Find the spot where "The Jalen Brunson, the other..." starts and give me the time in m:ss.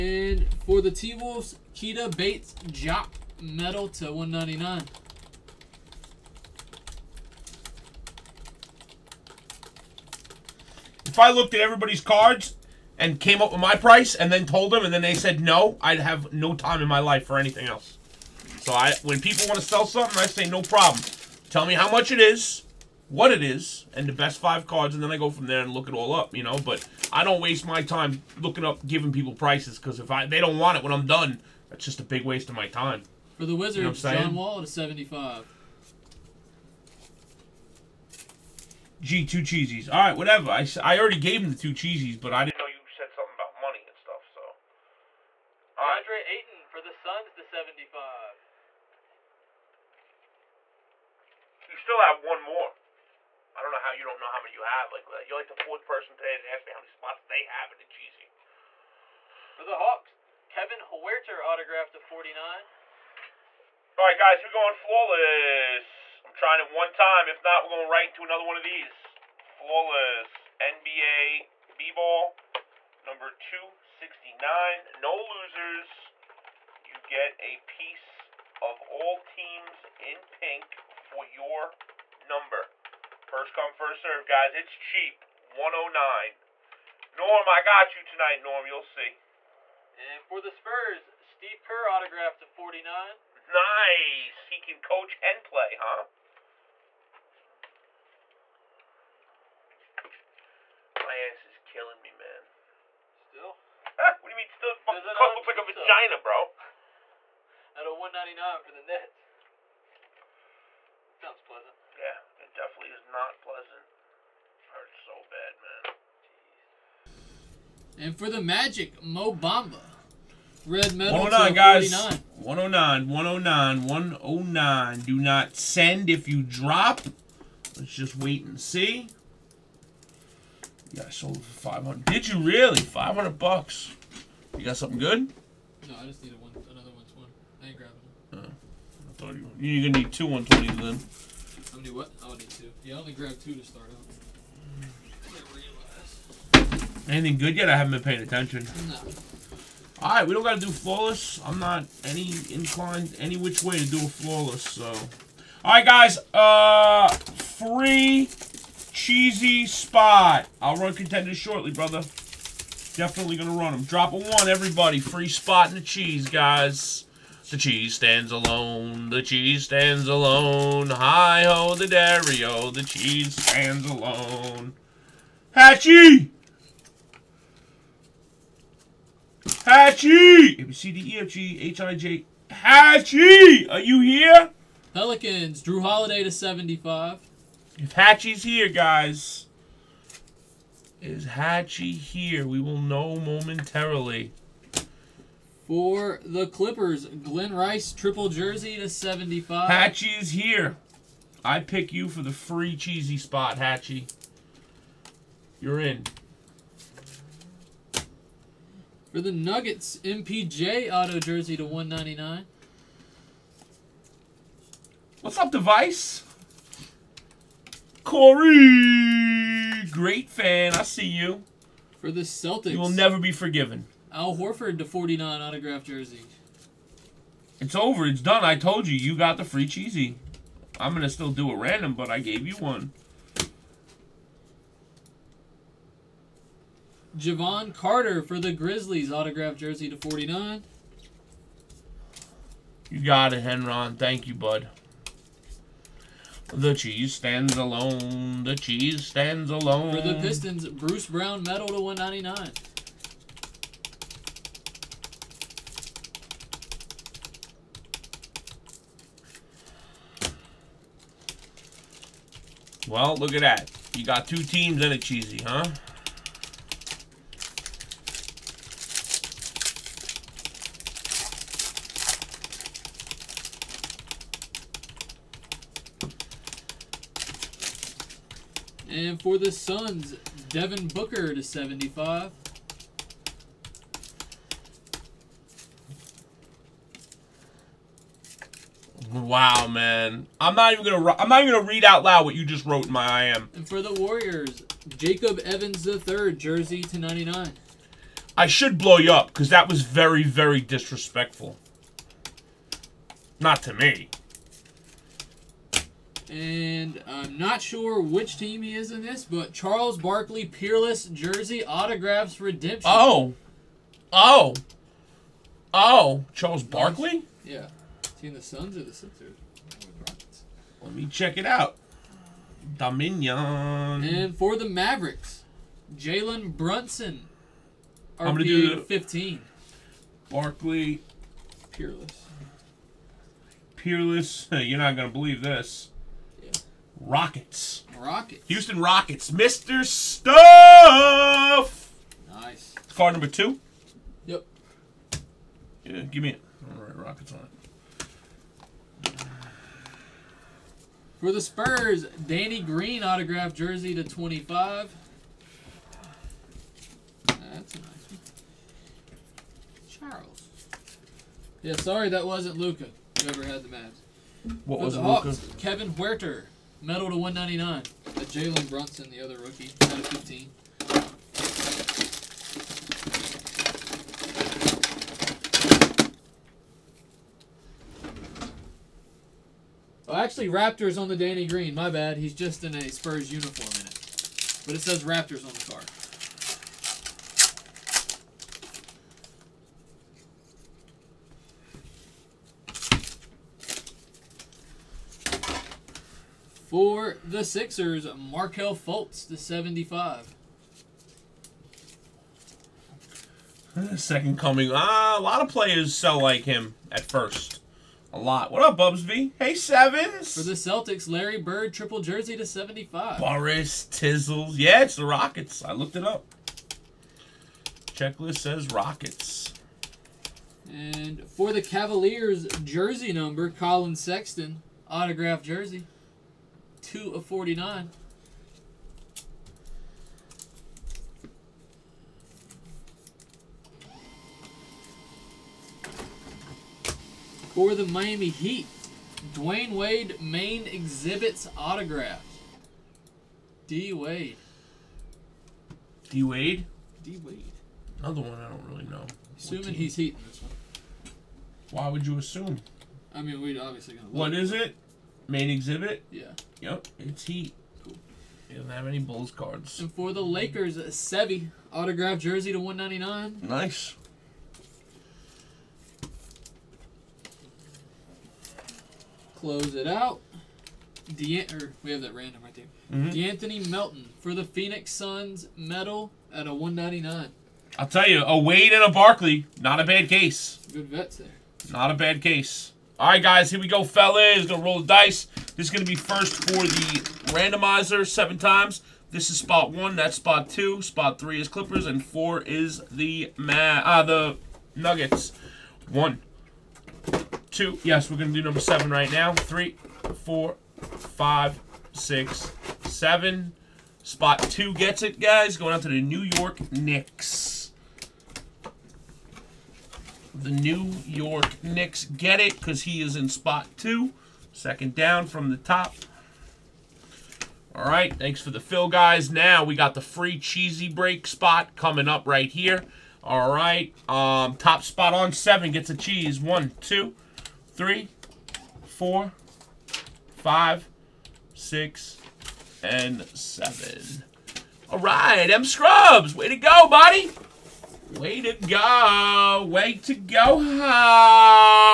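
6:08.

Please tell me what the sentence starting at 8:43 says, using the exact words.
All right, um, top spot on seven gets a cheese.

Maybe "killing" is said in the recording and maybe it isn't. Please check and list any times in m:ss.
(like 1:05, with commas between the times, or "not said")
1:41.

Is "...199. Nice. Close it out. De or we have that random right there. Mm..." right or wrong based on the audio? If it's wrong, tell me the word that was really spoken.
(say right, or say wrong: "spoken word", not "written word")
right.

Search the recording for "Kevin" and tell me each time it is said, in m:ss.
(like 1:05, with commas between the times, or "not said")
1:00, 6:05.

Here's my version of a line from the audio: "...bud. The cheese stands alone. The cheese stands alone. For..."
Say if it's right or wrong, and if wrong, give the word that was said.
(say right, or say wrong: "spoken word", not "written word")
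right.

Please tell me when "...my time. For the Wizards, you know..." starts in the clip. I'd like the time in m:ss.
0:32.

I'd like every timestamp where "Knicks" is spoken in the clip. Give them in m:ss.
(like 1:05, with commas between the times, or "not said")
8:26, 8:31.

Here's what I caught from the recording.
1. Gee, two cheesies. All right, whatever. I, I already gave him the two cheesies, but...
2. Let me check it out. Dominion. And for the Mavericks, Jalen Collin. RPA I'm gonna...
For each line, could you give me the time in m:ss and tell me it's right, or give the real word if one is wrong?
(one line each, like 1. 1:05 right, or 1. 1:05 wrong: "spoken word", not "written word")
1. 0:39 right
2. 5:20 wrong: "Brunson", not "Collin".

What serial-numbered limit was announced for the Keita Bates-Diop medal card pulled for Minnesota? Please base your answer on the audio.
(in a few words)
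199.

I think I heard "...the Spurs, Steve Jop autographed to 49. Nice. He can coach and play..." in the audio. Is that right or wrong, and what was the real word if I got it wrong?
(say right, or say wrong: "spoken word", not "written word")
wrong: "Kerr", not "Jop".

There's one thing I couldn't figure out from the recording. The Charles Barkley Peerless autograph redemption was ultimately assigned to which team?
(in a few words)
Houston Rockets.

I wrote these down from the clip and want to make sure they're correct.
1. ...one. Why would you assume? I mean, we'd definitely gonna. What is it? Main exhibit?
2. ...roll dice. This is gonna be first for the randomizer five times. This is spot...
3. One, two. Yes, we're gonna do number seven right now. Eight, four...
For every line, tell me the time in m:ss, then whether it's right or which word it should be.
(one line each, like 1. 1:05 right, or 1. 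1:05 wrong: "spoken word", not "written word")
1. 7:30 wrong: "obviously", not "definitely"
2. 8:04 wrong: "seven", not "five"
3. 8:15 wrong: "Three", not "Eight".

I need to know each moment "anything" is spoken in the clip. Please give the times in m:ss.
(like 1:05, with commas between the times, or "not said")
0:17, 2:27.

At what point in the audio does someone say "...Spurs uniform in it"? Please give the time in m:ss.
6:22.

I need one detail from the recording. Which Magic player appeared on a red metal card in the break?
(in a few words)
Mo Bamba.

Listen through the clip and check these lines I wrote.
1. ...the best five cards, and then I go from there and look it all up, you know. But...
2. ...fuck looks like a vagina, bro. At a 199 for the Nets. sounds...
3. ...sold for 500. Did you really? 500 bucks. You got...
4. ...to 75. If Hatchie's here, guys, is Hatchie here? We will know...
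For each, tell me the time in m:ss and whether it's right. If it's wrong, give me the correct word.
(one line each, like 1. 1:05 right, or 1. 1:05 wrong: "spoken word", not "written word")
1. 0:24 right
2. 1:45 right
3. 2:11 right
4. 3:06 right.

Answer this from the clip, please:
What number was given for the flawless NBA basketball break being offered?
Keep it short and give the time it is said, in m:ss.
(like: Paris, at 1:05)
269, at 1:13.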